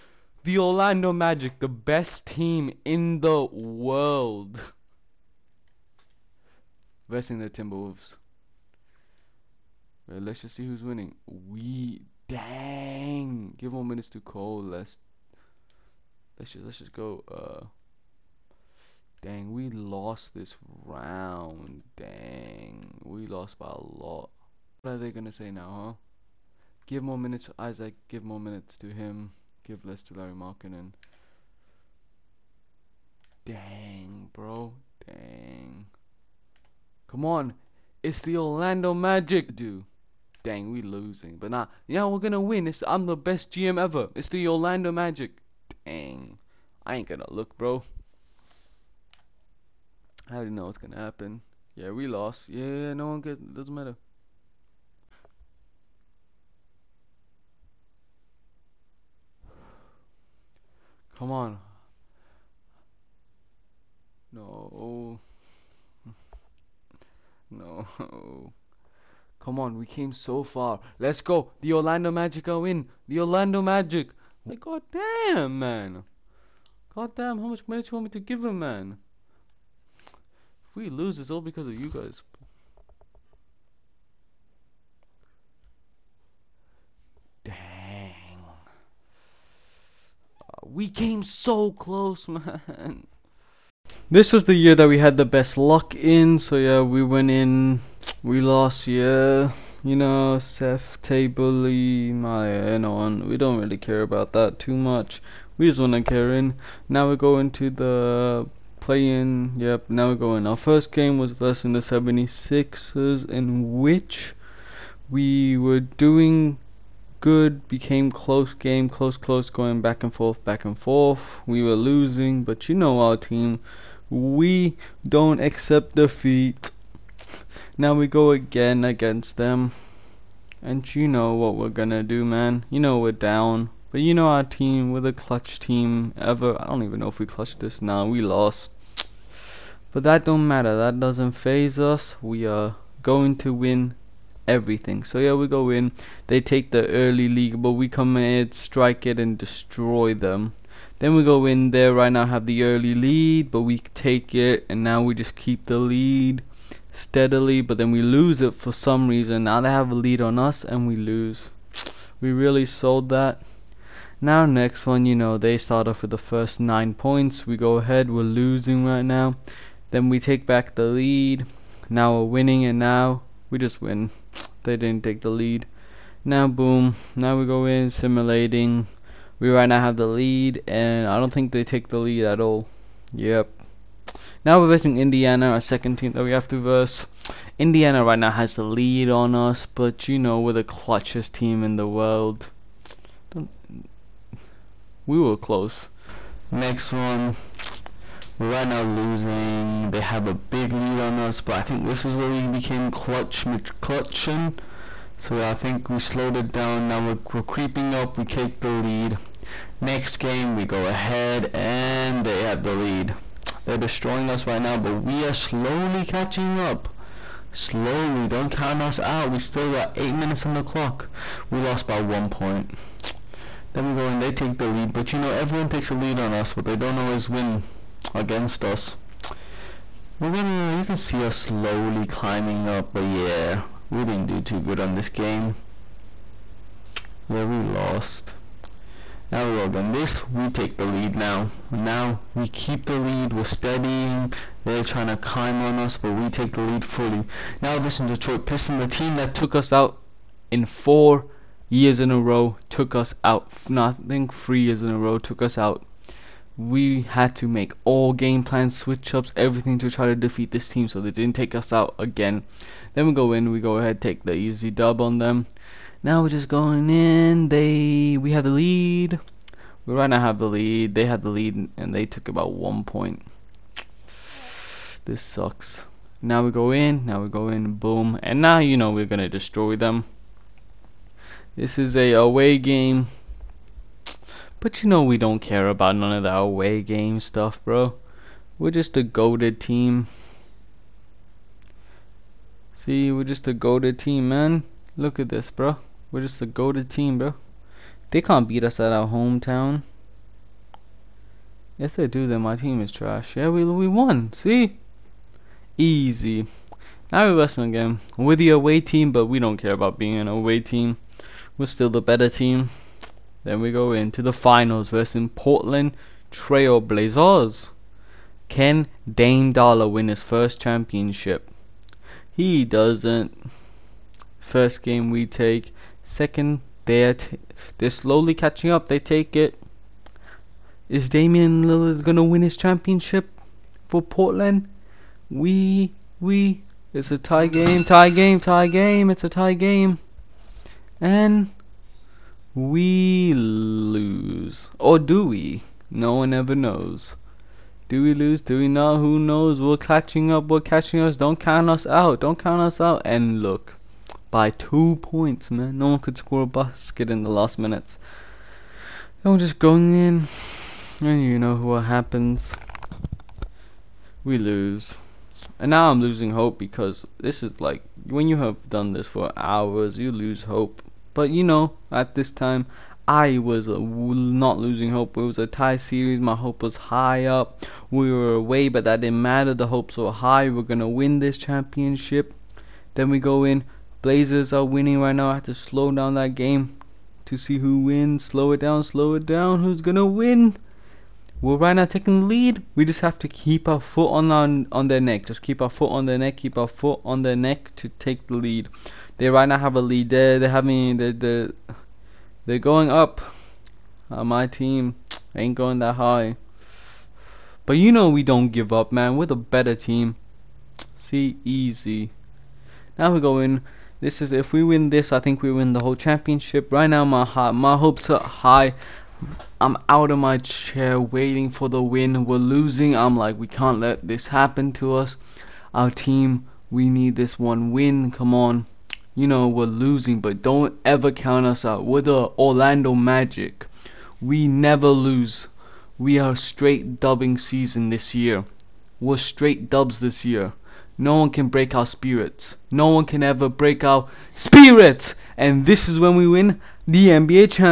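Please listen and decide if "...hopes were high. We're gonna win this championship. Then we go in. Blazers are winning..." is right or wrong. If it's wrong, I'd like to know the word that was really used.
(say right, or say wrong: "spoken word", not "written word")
right.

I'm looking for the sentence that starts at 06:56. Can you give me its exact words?
Right now, my my hopes are high.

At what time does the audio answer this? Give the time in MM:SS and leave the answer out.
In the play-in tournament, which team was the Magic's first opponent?
01:51.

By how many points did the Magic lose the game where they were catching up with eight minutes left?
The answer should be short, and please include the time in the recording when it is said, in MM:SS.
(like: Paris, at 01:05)
1, at 03:41.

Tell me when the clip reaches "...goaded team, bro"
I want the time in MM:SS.
04:56.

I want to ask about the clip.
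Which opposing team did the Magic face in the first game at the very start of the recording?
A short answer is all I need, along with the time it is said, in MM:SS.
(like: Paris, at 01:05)
Timberwolves, at 00:07.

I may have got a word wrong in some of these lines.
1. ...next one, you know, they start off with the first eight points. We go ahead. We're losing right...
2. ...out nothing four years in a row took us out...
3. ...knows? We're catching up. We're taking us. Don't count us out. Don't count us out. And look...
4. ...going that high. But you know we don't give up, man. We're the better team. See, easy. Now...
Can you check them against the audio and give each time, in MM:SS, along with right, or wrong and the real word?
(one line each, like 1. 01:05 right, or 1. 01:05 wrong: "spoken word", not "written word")
1. 02:44 wrong: "nine", not "eight"
2. 04:13 wrong: "three", not "four"
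3. 05:49 wrong: "catching", not "taking"
4. 06:45 right.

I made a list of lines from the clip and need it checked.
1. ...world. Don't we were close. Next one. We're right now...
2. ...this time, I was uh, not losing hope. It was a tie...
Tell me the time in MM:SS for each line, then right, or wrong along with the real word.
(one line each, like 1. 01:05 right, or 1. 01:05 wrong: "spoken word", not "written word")
1. 03:11 right
2. 06:12 right.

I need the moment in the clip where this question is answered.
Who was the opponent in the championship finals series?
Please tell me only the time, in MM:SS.
05:15.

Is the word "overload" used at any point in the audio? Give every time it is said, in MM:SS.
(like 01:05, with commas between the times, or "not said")
not said.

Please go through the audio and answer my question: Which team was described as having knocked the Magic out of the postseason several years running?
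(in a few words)
Detroit Pistons.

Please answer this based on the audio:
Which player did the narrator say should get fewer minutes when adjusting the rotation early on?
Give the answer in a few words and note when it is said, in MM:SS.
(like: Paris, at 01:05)
Lauri Markkanen, at 00:30.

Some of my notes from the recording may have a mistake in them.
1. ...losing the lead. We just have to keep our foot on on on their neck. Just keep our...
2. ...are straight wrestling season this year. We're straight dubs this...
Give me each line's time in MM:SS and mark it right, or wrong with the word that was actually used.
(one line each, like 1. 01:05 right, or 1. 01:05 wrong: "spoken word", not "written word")
1. 06:31 wrong: "taking", not "losing"
2. 07:16 wrong: "dubbing", not "wrestling".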